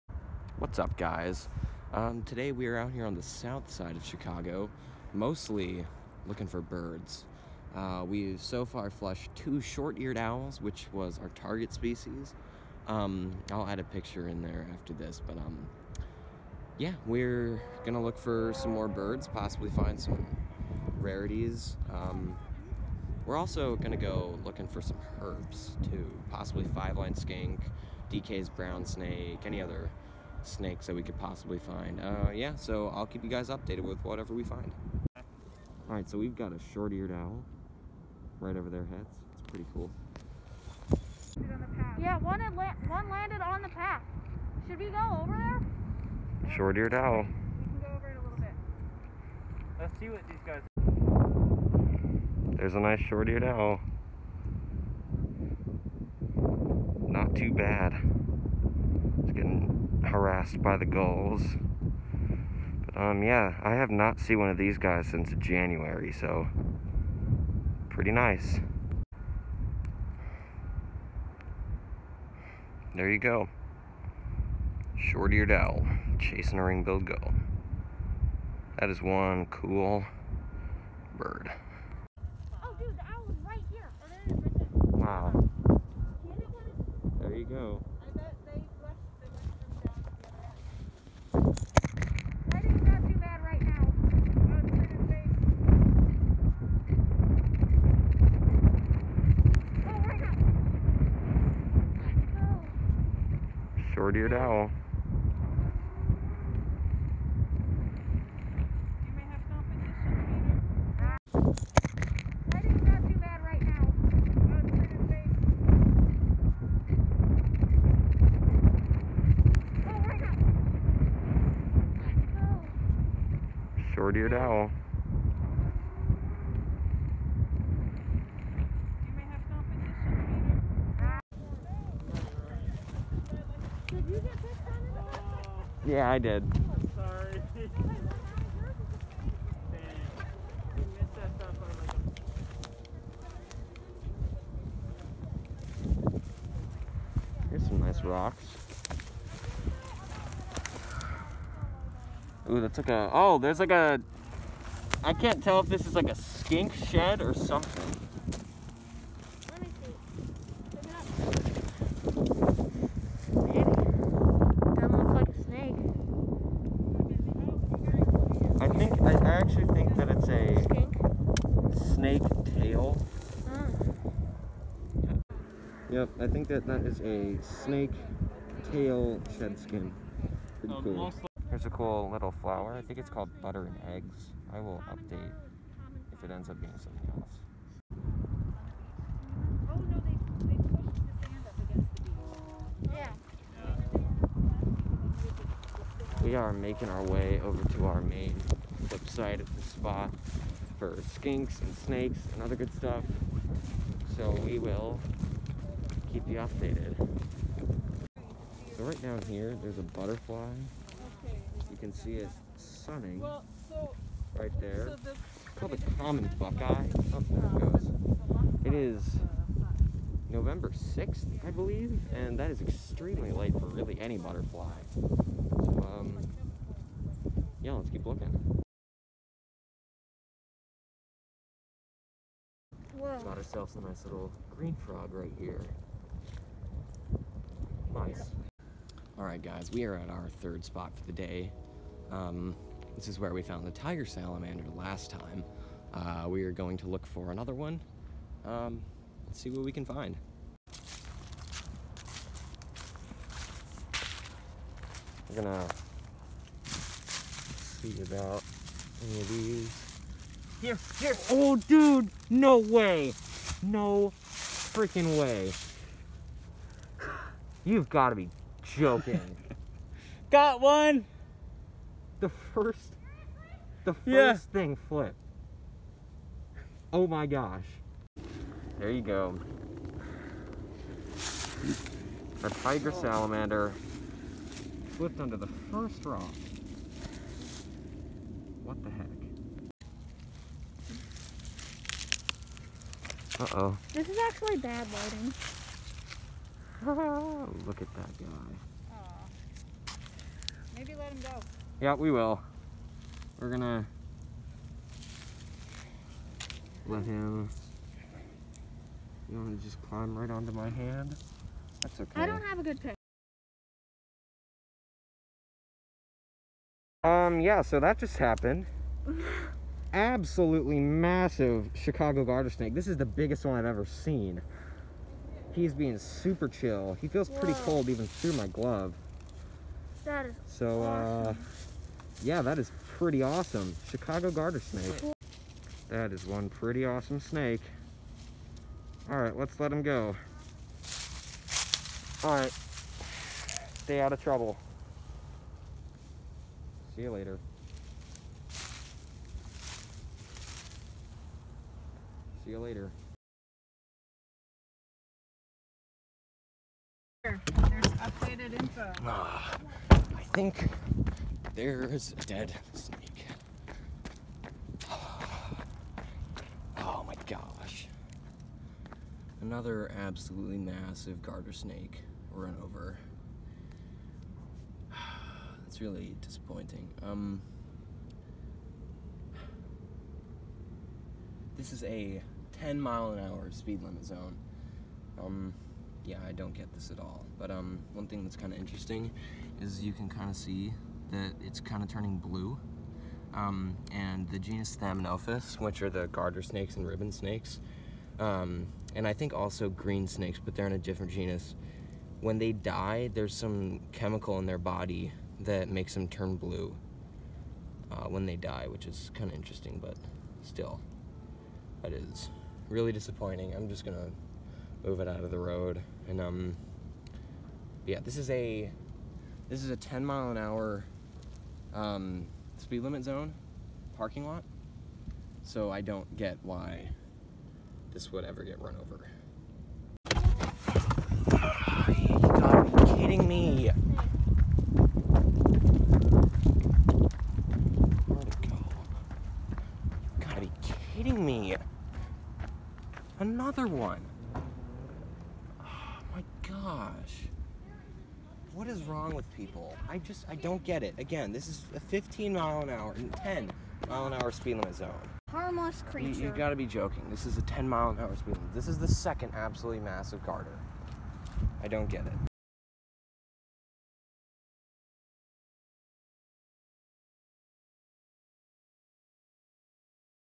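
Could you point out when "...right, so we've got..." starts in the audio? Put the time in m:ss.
0:35.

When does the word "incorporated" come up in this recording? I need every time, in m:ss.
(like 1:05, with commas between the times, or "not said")
not said.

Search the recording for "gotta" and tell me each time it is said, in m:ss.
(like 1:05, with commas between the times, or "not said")
7:12, 7:20, 7:36.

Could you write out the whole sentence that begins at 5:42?
All right, stay out of trouble.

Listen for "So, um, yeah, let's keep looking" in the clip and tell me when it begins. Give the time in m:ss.
3:44.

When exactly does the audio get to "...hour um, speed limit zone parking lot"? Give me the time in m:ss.
7:00.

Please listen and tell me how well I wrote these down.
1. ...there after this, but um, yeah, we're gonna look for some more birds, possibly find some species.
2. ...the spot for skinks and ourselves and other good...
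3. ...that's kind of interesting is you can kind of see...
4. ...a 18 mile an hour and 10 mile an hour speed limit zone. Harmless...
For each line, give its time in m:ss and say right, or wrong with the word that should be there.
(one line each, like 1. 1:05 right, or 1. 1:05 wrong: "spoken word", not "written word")
1. 0:14 wrong: "rarities", not "species"
2. 3:19 wrong: "snakes", not "ourselves"
3. 6:28 right
4. 7:31 wrong: "15", not "18".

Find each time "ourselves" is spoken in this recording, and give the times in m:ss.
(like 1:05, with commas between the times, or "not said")
3:53.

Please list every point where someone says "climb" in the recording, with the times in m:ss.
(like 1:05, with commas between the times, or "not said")
5:09.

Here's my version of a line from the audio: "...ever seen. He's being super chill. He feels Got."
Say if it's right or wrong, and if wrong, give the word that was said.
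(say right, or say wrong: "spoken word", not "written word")
wrong: "Whoa", not "Got".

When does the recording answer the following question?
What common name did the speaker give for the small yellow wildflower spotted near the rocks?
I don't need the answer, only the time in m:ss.
3:03.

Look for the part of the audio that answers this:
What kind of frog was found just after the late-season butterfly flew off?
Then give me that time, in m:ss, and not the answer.
3:54.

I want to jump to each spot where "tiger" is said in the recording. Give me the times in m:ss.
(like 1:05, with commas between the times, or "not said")
4:03, 4:42.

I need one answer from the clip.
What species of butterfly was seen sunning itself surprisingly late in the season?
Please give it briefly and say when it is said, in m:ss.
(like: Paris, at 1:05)
Common buckeye, at 3:35.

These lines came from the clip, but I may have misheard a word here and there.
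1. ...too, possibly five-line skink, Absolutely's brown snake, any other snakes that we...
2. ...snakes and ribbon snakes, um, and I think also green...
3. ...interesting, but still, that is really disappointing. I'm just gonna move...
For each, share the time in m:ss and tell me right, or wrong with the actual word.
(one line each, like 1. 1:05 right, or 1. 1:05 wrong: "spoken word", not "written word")
1. 0:25 wrong: "DeKay", not "Absolutely"
2. 6:36 right
3. 6:49 right.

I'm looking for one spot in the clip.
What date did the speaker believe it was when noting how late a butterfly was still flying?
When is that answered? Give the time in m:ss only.
3:40.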